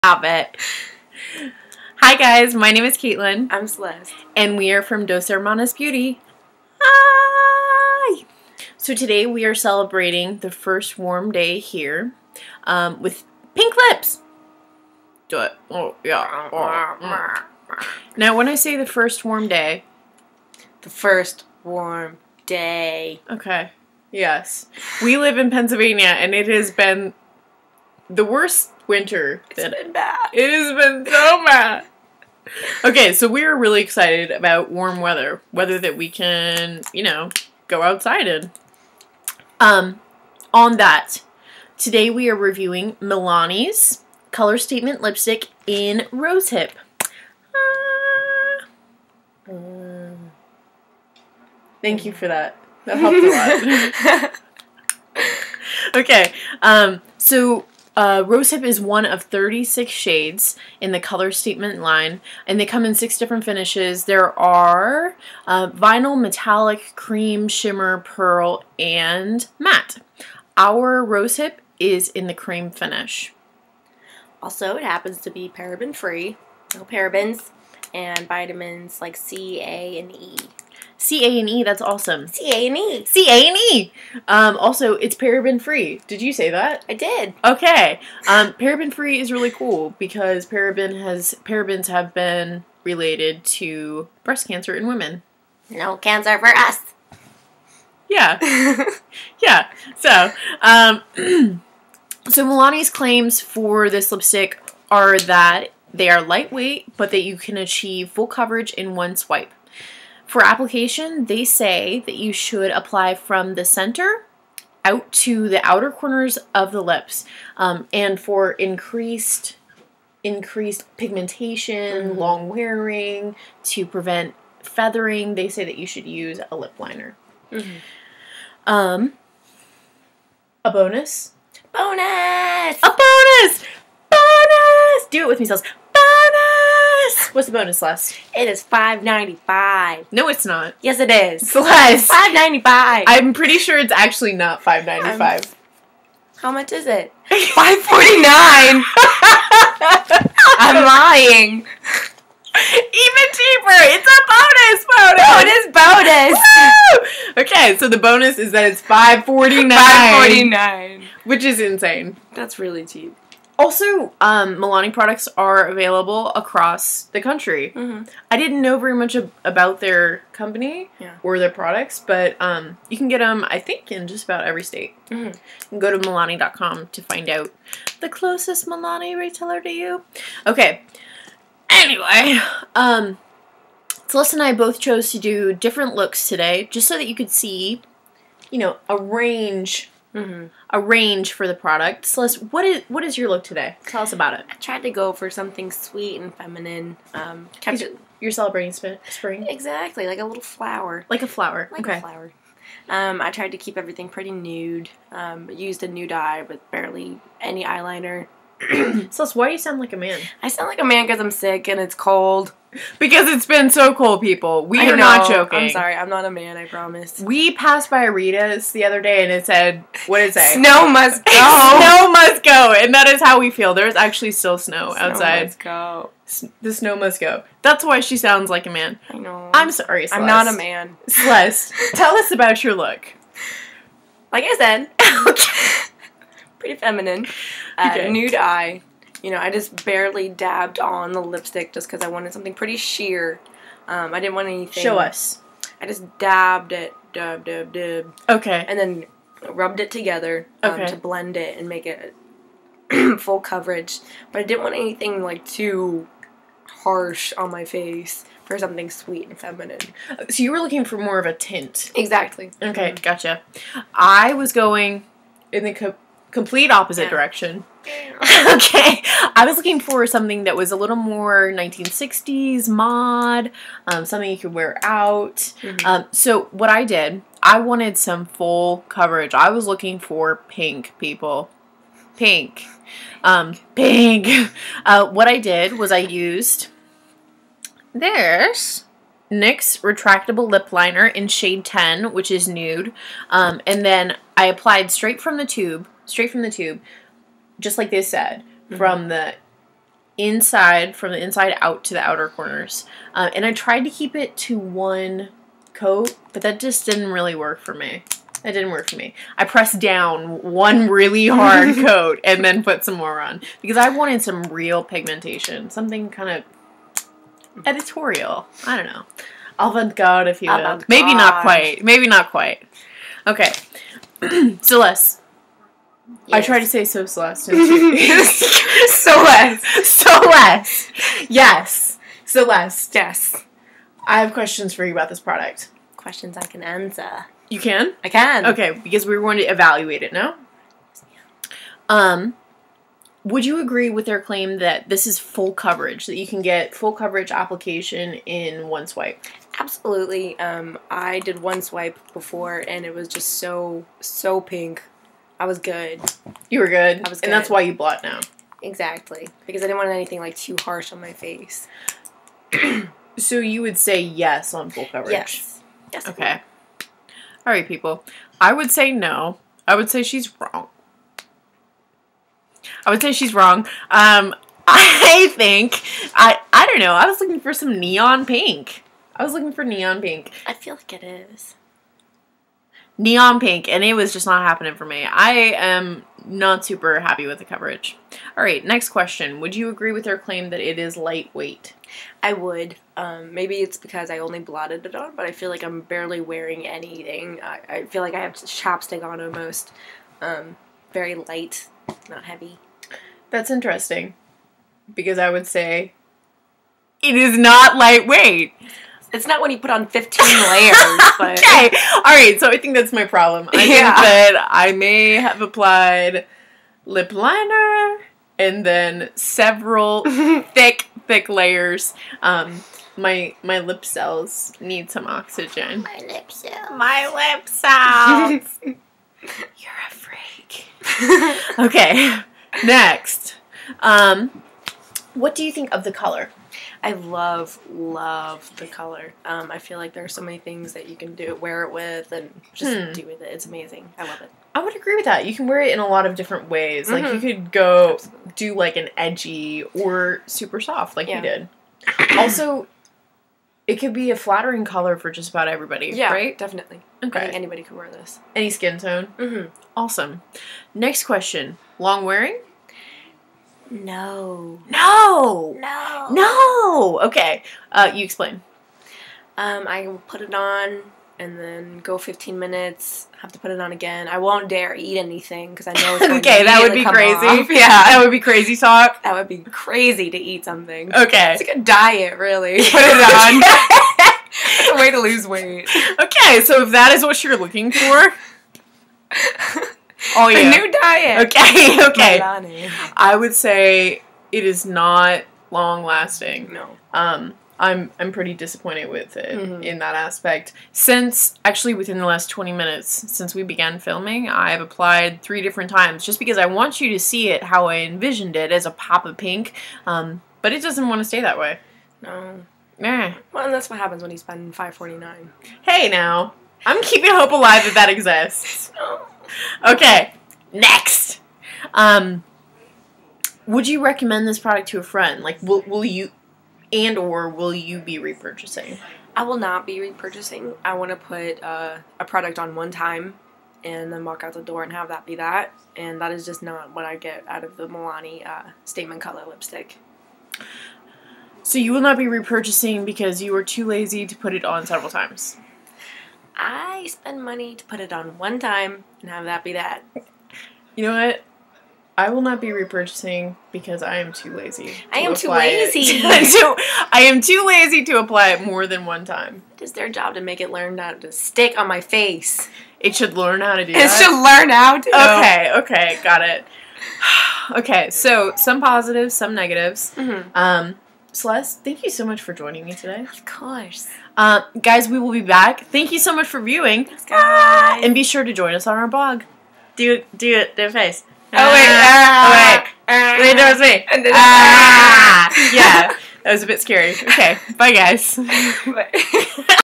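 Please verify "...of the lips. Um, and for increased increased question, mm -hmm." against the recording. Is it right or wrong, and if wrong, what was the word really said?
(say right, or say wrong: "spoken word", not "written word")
wrong: "pigmentation", not "question".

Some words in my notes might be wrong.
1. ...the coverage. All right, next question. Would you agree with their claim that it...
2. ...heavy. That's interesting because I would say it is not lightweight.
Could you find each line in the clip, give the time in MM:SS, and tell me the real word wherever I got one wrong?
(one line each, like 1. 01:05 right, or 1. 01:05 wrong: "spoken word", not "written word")
1. 06:27 right
2. 06:42 right.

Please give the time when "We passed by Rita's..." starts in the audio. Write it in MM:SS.
03:37.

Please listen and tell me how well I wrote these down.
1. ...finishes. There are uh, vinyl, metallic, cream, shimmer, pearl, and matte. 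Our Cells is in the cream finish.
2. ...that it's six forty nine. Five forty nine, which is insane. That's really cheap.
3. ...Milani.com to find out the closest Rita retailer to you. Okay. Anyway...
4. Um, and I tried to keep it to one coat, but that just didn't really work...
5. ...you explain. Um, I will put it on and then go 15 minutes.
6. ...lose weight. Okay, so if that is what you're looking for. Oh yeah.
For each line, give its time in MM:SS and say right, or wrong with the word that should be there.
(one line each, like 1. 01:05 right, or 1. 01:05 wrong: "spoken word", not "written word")
1. 01:03 wrong: "Rosehip", not "Cells"
2. 02:38 wrong: "five", not "six"
3. 02:55 wrong: "Milani", not "Rita"
4. 05:03 right
5. 07:47 right
6. 08:04 right.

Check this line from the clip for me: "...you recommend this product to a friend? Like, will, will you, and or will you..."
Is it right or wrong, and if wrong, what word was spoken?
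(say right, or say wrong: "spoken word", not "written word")
right.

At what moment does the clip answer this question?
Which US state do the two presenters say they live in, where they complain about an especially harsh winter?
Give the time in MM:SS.
00:25.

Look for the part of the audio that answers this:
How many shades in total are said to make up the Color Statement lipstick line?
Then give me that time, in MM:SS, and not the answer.
00:59.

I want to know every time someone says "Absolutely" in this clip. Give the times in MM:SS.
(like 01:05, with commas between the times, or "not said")
05:49, 07:27.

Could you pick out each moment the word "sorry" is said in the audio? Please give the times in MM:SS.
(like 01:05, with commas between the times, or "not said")
03:35, 03:49.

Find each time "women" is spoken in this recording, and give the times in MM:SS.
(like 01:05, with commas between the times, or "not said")
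01:34.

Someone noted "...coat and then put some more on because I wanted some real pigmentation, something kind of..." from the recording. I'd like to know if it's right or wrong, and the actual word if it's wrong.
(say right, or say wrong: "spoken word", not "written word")
right.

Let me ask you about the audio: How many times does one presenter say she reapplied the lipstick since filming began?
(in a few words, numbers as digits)
3.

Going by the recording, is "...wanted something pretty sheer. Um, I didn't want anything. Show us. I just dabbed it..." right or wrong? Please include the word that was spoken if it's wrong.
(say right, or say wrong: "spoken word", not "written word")
right.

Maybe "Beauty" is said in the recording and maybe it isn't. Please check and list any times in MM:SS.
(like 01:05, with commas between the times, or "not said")
00:05.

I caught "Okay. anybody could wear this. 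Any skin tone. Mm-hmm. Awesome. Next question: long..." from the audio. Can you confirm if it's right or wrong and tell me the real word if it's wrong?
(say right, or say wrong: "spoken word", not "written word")
right.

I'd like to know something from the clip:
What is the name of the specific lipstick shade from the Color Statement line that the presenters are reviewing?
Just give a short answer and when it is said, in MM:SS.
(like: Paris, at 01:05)
Rose Hip, at 00:46.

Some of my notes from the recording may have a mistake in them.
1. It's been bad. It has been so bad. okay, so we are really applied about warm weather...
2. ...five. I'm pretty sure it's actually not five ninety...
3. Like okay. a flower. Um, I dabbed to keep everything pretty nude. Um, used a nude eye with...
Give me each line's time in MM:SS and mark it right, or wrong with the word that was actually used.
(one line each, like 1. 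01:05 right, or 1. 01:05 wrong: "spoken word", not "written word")
1. 00:29 wrong: "excited", not "applied"
2. 02:22 right
3. 03:21 wrong: "tried", not "dabbed".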